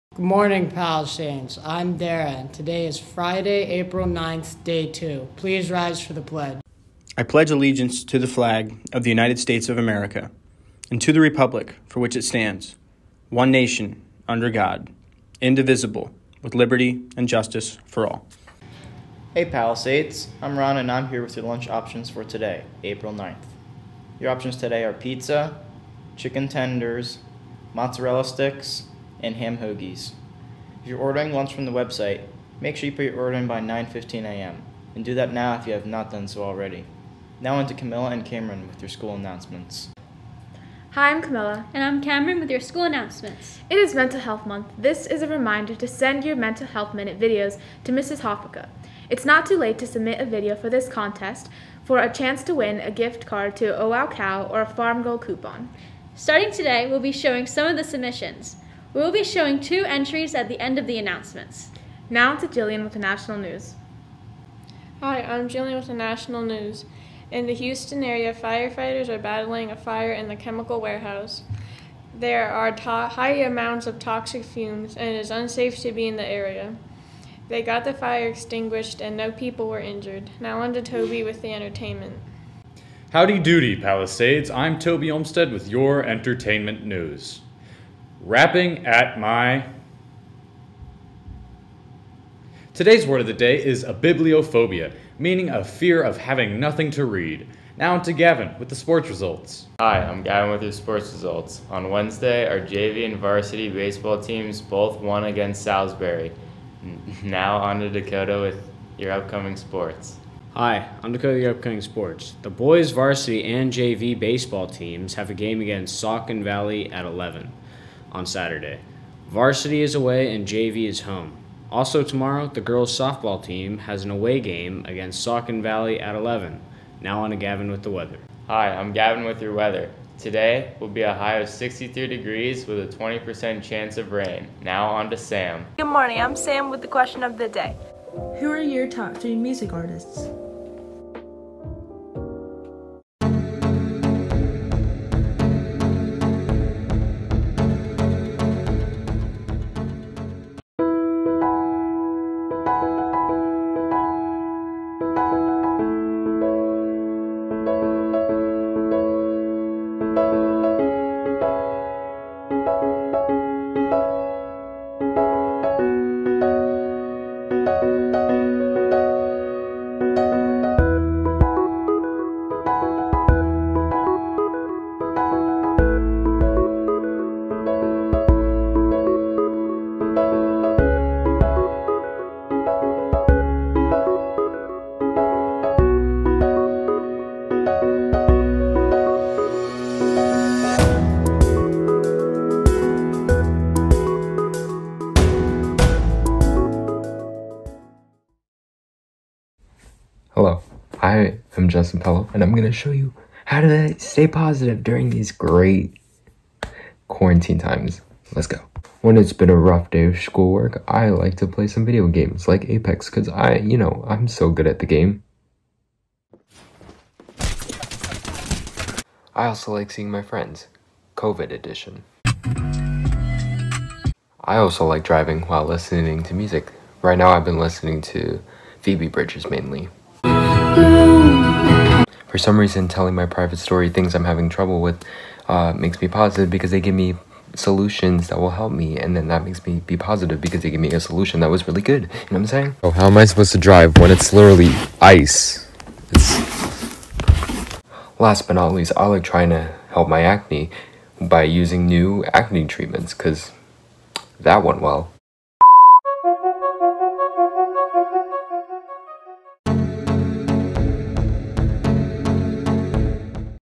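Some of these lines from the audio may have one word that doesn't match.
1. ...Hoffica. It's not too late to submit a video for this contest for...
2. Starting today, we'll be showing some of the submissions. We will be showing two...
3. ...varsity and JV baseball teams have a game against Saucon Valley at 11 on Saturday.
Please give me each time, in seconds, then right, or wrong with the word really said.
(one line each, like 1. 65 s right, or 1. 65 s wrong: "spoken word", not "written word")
1. 48 s right
2. 56 s right
3. 112 s right.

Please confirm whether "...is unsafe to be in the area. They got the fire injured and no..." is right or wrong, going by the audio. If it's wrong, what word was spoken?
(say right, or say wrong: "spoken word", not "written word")
wrong: "extinguished", not "injured".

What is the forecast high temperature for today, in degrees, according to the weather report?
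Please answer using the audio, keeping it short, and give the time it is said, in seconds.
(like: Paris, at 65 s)
63, at 131 s.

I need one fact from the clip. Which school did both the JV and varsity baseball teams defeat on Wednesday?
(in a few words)
Salisbury.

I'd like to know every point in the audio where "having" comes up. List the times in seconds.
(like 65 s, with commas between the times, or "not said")
96 s, 234 s.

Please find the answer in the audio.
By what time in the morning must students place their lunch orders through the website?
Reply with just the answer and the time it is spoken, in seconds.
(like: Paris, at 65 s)
9:15 a.m., at 33 s.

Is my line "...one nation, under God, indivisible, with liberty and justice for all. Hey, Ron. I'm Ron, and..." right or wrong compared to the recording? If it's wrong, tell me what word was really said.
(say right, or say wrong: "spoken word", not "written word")
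wrong: "Palisades", not "Ron".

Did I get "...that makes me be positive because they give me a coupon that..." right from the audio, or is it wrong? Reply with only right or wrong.
wrong.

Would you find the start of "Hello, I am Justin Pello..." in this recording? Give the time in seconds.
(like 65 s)
200 s.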